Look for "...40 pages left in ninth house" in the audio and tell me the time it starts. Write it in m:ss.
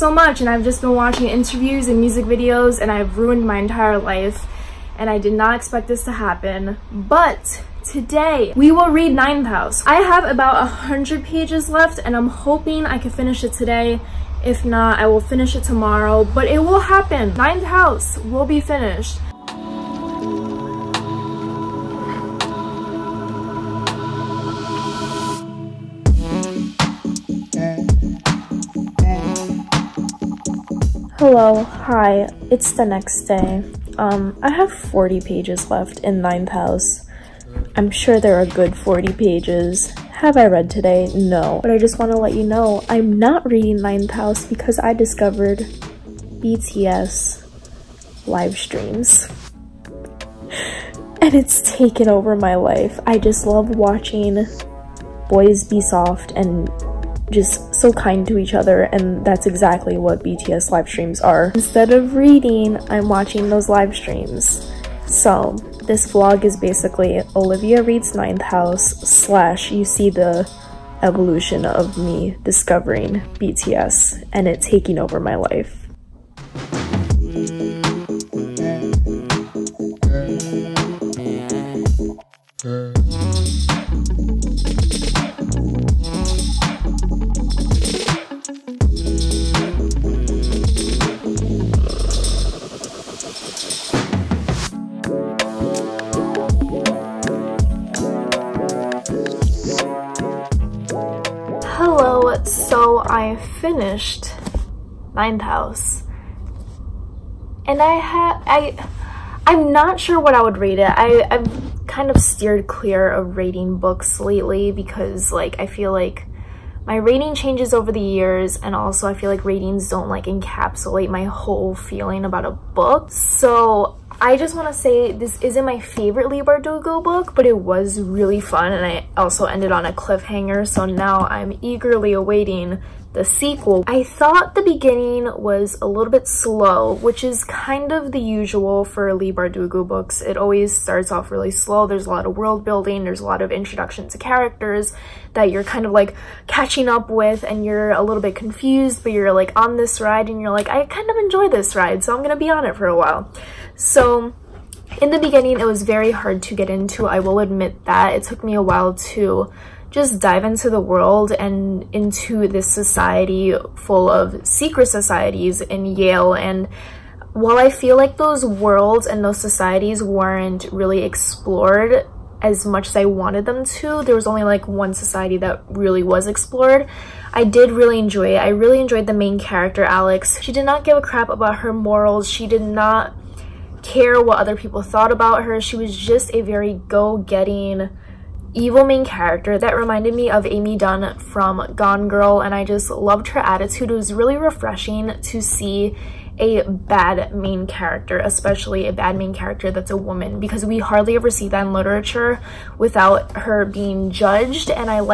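0:34.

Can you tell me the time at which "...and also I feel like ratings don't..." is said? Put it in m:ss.
1:58.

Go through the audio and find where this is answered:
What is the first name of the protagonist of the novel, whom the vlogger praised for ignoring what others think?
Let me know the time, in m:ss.
2:59.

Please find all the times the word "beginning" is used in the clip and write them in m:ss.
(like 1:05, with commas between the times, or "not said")
2:14, 2:35.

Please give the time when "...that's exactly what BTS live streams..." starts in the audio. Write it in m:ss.
0:59.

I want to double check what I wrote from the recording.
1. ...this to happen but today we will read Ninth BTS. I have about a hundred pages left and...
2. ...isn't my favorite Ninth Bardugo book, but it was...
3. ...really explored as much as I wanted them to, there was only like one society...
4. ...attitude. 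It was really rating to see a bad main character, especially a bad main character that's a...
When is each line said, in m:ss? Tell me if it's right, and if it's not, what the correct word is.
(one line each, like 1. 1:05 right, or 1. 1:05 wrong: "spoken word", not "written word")
1. 0:05 wrong: "House", not "BTS"
2. 2:05 wrong: "Leigh", not "Ninth"
3. 2:50 right
4. 3:13 wrong: "refreshing", not "rating".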